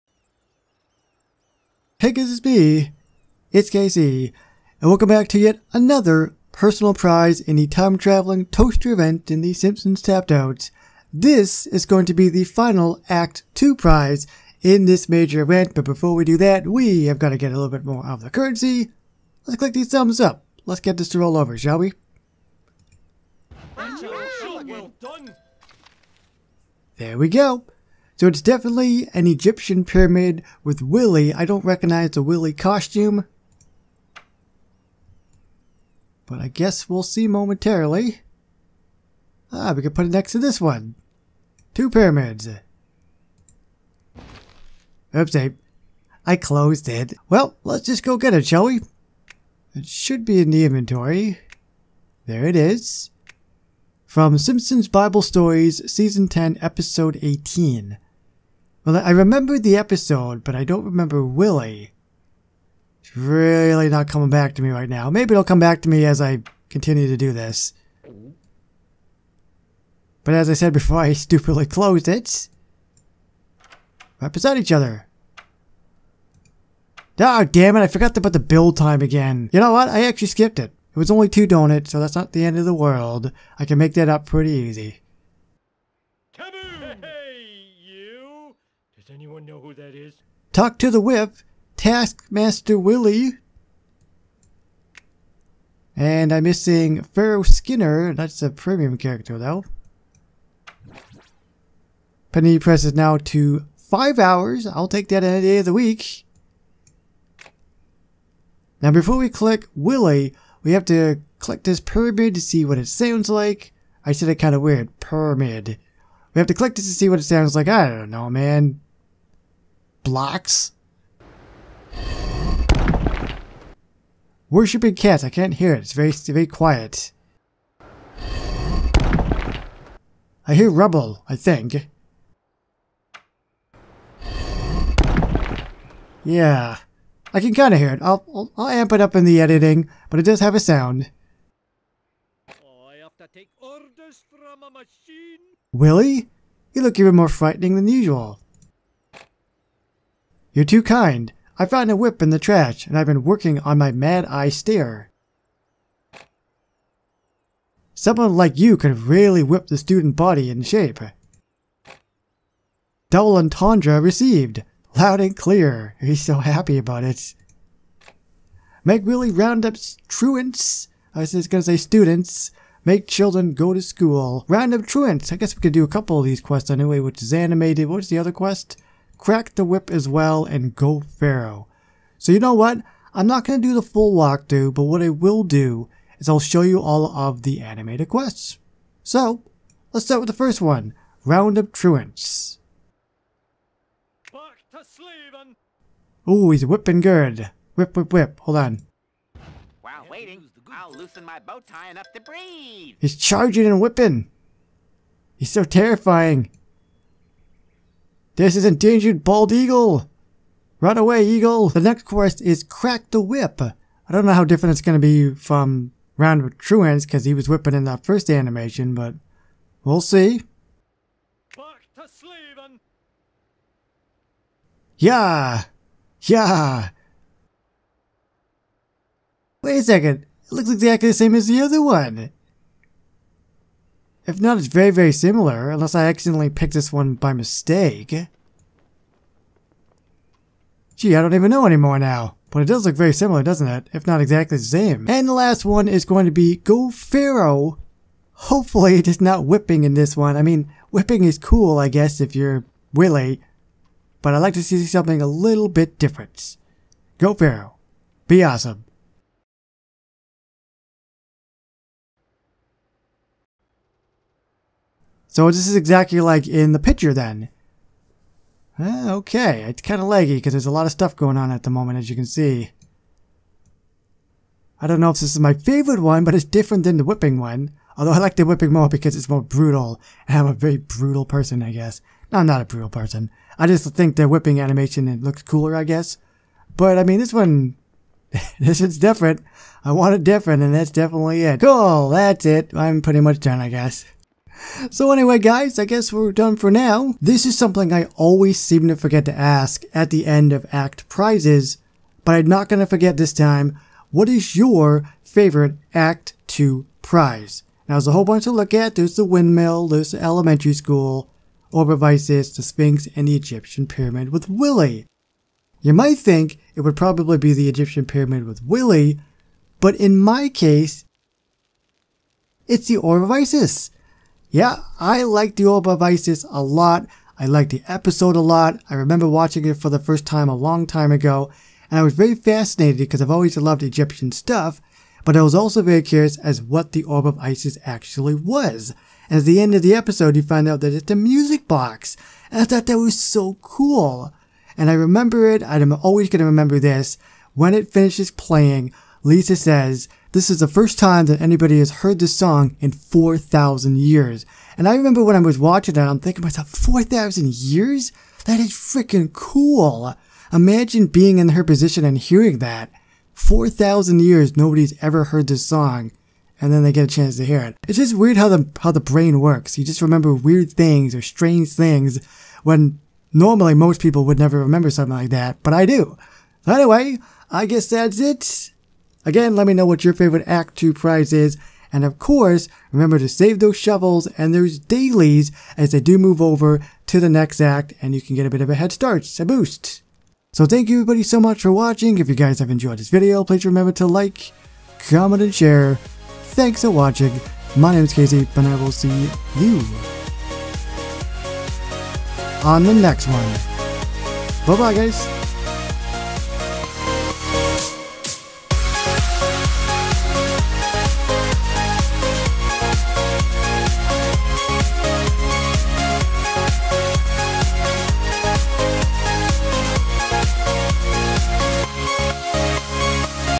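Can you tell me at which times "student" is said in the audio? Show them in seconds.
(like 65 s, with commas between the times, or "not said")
159 s, 171 s.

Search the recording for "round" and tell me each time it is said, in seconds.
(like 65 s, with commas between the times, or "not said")
169 s, 174 s, 191 s, 216 s.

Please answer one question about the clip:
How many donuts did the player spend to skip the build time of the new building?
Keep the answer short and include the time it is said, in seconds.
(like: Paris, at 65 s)
2, at 81 s.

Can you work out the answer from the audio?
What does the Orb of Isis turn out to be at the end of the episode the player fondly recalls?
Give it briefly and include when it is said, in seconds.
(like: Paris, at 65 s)
a music box, at 341 s.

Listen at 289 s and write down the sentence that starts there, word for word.
I want it different, and that's definitely it.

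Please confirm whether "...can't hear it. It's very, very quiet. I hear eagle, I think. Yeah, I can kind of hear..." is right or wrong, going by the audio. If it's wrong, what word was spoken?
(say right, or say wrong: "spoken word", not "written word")
wrong: "rubble", not "eagle".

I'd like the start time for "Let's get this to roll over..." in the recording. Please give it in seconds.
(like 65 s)
20 s.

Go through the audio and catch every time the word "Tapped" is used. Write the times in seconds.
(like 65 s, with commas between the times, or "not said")
10 s.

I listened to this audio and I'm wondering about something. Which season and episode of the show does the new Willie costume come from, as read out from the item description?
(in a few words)
Season 10, Episode 18.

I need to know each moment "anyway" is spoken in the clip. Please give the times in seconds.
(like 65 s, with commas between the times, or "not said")
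176 s, 295 s, 376 s.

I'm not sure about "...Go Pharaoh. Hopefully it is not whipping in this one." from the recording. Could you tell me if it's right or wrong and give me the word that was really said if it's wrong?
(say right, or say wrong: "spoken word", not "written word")
right.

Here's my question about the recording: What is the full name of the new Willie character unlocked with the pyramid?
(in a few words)
Taskmaster Willie.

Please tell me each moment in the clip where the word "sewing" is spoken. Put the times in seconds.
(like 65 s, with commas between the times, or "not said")
not said.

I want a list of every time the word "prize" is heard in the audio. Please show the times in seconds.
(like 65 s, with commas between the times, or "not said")
6 s, 13 s, 301 s, 307 s, 380 s.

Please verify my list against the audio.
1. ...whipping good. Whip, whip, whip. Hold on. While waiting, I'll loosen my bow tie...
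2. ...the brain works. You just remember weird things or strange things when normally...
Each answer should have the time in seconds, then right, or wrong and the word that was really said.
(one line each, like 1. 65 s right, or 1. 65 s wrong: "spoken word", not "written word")
1. 196 s right
2. 368 s right.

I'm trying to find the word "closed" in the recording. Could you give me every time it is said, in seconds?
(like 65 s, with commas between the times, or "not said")
46 s, 71 s.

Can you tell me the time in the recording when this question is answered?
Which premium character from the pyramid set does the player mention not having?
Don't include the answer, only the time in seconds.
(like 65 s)
97 s.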